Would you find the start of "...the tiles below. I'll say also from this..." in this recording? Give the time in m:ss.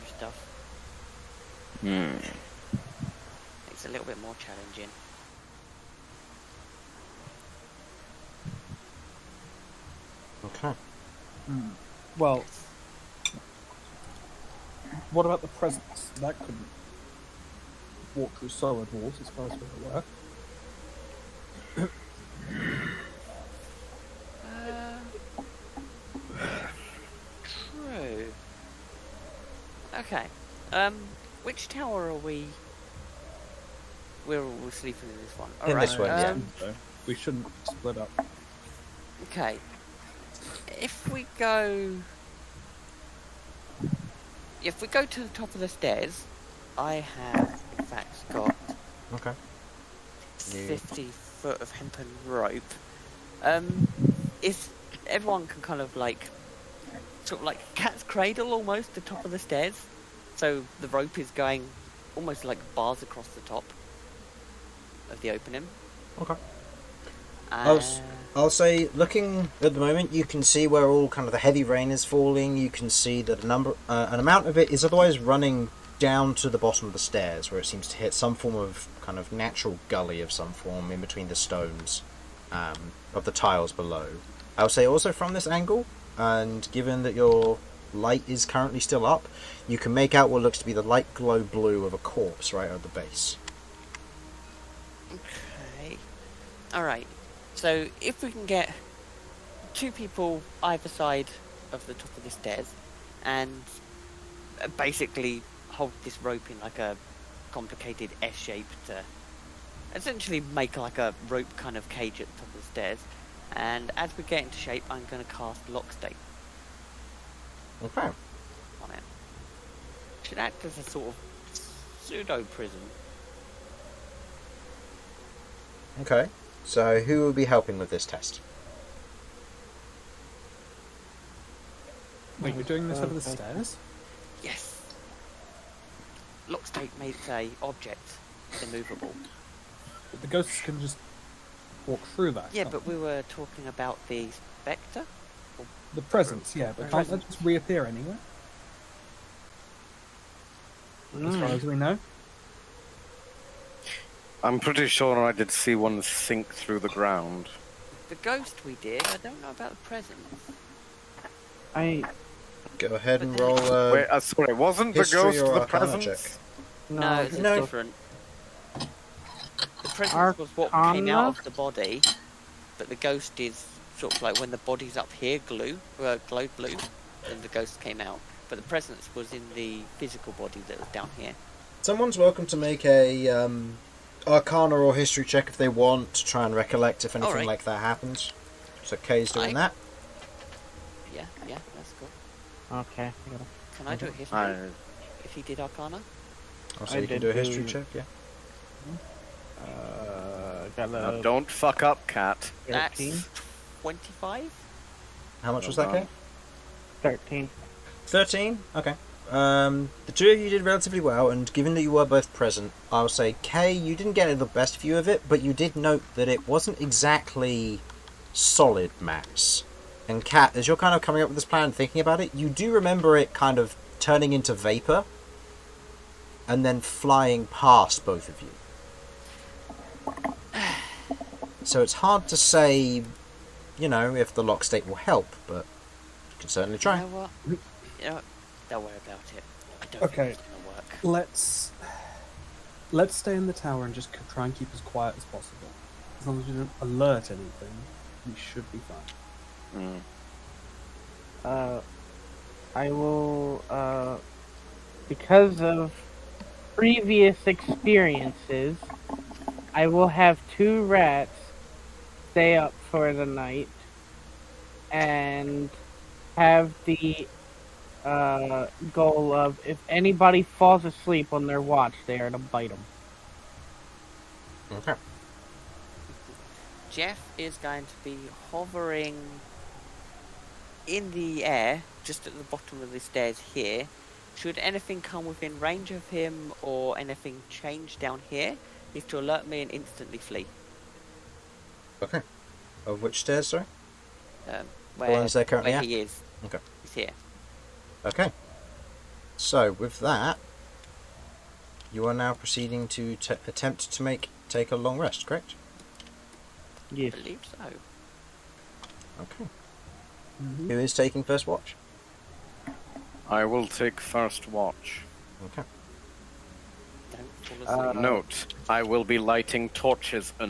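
1:23.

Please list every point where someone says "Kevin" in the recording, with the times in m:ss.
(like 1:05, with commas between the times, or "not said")
not said.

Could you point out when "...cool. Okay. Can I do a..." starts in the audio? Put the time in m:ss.
3:11.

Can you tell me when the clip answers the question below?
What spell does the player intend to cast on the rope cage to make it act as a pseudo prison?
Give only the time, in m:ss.
2:16.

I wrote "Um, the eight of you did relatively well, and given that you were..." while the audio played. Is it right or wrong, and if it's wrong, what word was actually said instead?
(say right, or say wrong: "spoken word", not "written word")
wrong: "two", not "eight".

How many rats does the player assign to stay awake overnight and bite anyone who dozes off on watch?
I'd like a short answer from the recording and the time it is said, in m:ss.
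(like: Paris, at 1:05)
2, at 4:20.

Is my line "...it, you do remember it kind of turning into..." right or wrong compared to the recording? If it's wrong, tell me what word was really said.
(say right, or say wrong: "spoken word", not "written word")
right.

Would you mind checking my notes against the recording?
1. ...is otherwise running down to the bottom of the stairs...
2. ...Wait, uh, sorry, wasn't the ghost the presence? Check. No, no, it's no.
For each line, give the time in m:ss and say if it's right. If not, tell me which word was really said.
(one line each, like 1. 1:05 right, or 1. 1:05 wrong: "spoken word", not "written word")
1. 1:14 right
2. 2:43 right.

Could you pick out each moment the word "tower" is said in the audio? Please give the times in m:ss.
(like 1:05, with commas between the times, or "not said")
0:31, 4:03.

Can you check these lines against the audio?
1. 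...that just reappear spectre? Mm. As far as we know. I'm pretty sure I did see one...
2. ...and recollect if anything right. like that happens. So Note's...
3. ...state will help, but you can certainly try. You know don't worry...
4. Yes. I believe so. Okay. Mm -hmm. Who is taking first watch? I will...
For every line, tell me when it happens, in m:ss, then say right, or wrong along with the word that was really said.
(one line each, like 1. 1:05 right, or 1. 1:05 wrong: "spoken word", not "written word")
1. 2:27 wrong: "anywhere", not "spectre"
2. 3:06 wrong: "Kay", not "Note"
3. 3:54 right
4. 5:06 right.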